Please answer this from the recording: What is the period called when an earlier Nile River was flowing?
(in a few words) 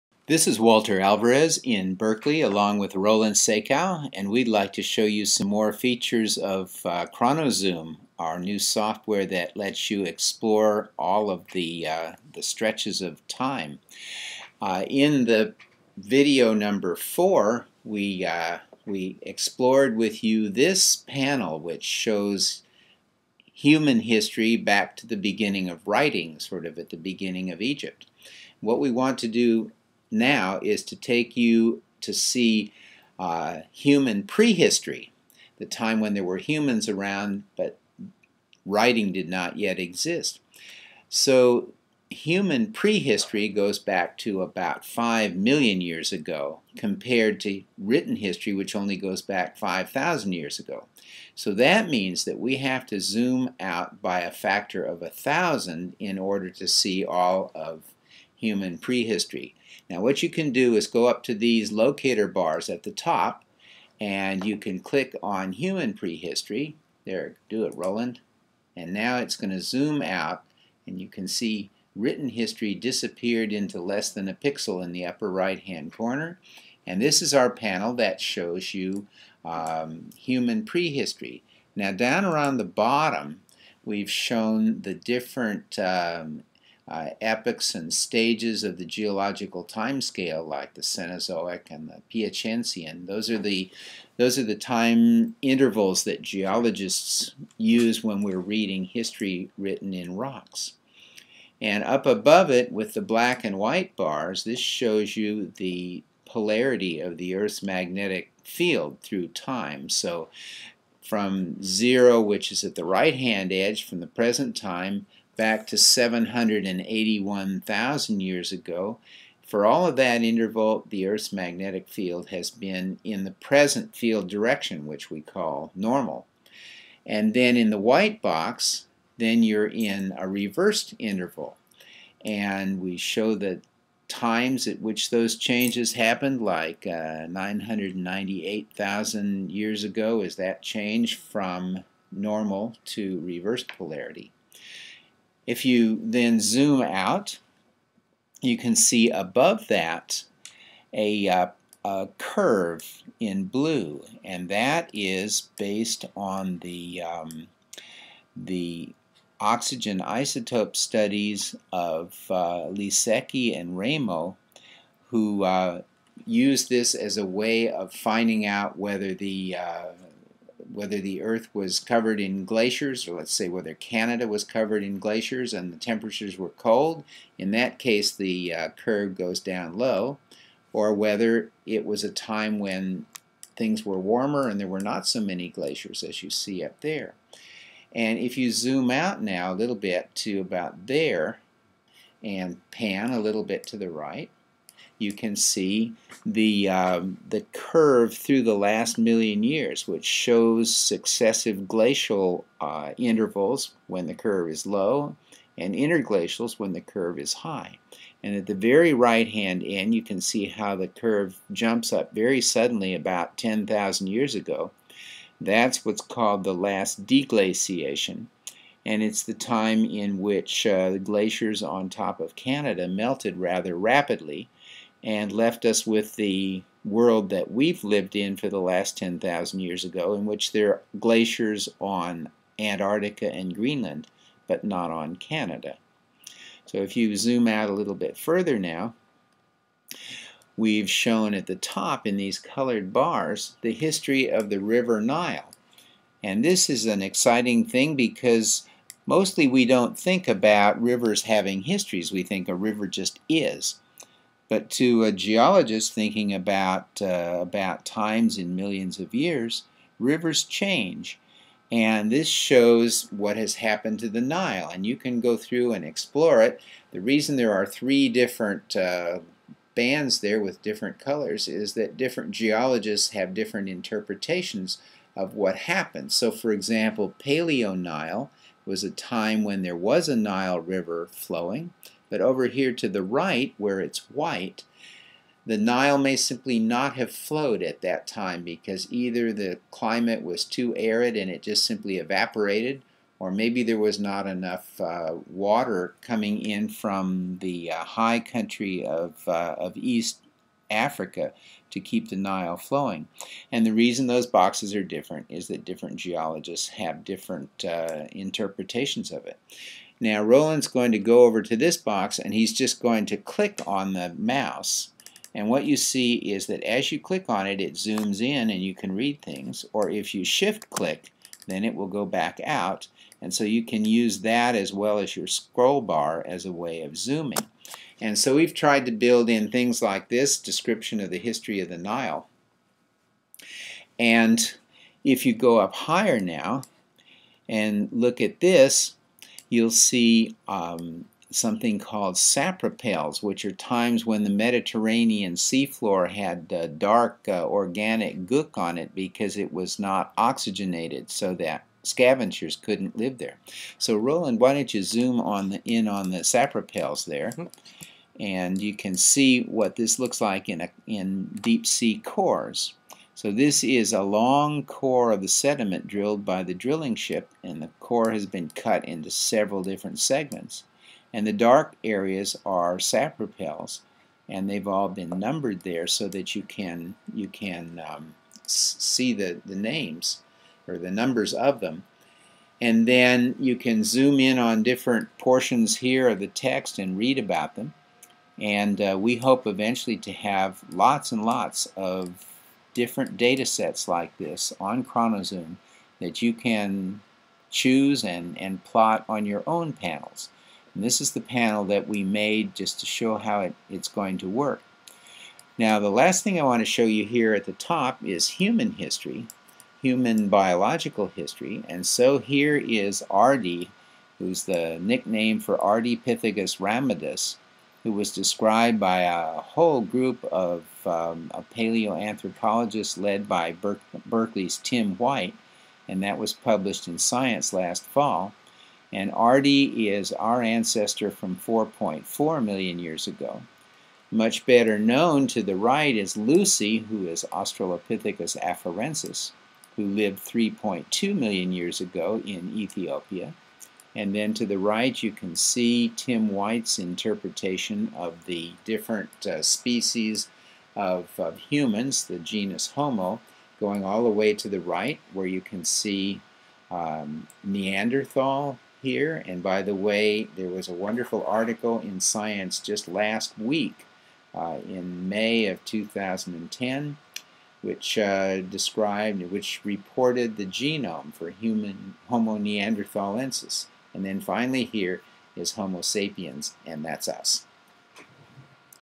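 Paleo Nile.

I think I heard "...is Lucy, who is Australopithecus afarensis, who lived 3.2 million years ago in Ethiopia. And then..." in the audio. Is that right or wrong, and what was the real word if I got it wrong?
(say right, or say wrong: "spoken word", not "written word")
right.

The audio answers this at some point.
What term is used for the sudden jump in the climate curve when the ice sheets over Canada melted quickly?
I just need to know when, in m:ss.
3:36.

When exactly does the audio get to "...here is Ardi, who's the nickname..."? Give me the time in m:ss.
6:52.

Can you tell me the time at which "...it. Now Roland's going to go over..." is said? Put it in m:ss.
5:09.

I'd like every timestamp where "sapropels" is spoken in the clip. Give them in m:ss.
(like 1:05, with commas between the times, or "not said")
5:42, 5:56, 6:12.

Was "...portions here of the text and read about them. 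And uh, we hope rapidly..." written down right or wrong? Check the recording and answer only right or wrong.
wrong.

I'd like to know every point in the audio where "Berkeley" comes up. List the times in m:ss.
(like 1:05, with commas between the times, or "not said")
0:01, 7:04.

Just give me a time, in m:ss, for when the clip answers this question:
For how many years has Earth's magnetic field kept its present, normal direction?
1:55.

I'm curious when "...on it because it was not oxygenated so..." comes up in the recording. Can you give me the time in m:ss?
5:48.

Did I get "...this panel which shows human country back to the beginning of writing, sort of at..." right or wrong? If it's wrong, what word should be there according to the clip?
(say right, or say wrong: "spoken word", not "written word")
wrong: "history", not "country".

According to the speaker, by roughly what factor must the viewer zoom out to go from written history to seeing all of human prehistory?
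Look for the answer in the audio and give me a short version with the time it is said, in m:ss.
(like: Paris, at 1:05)
1,000, at 0:54.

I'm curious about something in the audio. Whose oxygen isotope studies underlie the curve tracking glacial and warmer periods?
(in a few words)
Lisiecki and Raymo.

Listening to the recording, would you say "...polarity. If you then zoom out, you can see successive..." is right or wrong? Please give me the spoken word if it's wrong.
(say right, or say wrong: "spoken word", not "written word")
wrong: "above", not "successive".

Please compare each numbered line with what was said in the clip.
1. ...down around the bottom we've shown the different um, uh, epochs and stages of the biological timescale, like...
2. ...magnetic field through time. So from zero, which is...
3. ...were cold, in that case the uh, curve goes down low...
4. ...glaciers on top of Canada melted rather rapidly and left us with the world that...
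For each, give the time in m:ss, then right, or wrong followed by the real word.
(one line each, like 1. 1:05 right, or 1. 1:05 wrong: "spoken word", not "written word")
1. 1:21 wrong: "geological", not "biological"
2. 1:47 right
3. 2:56 right
4. 3:40 right.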